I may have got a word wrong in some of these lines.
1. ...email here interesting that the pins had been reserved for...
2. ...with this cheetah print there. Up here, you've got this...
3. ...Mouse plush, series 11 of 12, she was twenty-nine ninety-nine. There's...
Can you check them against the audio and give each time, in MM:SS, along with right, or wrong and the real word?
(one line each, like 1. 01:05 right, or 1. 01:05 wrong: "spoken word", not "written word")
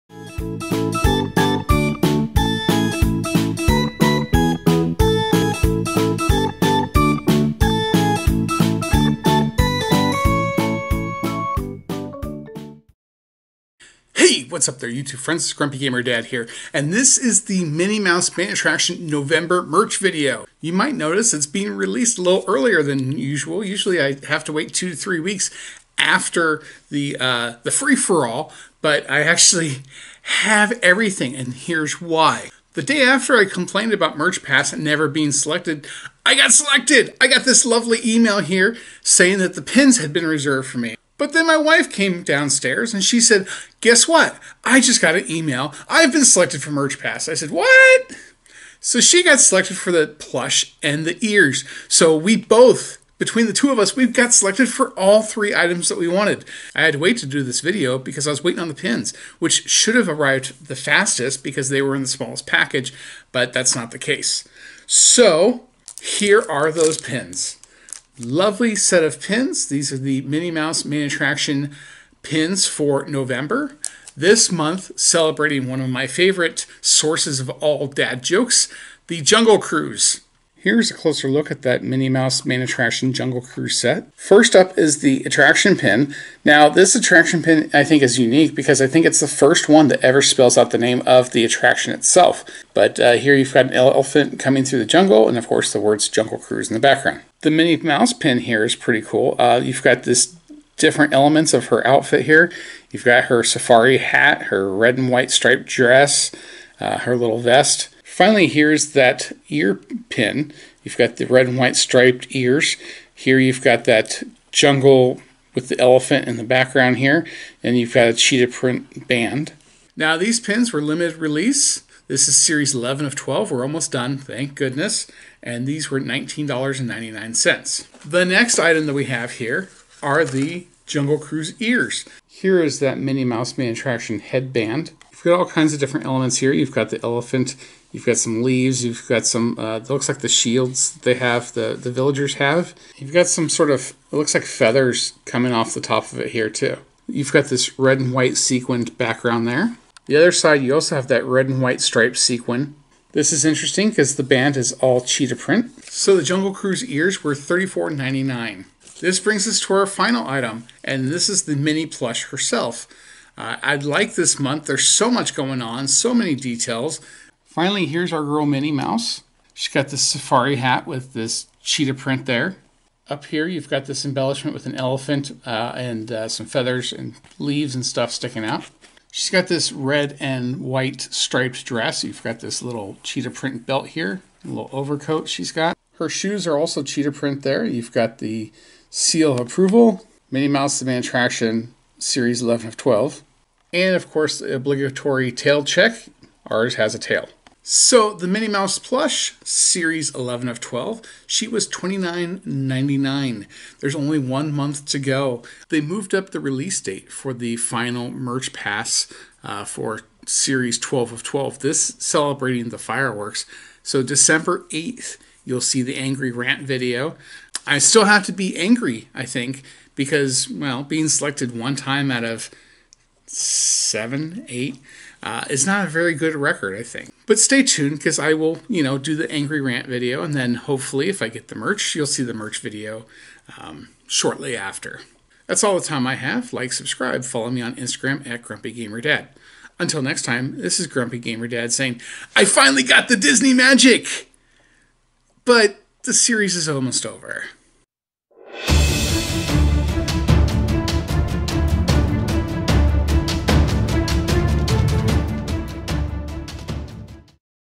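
1. 00:38 wrong: "saying", not "interesting"
2. 02:50 right
3. 03:18 right.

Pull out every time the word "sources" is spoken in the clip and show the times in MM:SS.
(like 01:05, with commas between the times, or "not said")
01:16.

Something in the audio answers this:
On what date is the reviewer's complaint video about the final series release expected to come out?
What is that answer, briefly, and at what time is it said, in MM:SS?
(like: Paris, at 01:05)
December 8th, at 03:34.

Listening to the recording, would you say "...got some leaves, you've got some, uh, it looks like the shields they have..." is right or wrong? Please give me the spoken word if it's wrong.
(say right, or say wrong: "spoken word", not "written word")
right.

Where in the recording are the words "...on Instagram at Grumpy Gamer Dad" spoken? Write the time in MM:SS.
03:57.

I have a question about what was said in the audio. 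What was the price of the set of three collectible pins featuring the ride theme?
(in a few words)
$19.99.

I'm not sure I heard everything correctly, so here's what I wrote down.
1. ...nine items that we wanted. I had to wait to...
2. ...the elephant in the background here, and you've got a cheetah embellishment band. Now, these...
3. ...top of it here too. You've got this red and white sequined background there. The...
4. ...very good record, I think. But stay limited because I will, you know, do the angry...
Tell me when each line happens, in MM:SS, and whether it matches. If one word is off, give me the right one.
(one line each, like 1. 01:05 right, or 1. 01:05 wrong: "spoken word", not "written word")
1. 00:55 wrong: "three", not "nine"
2. 01:55 wrong: "print", not "embellishment"
3. 02:25 right
4. 03:45 wrong: "tuned", not "limited".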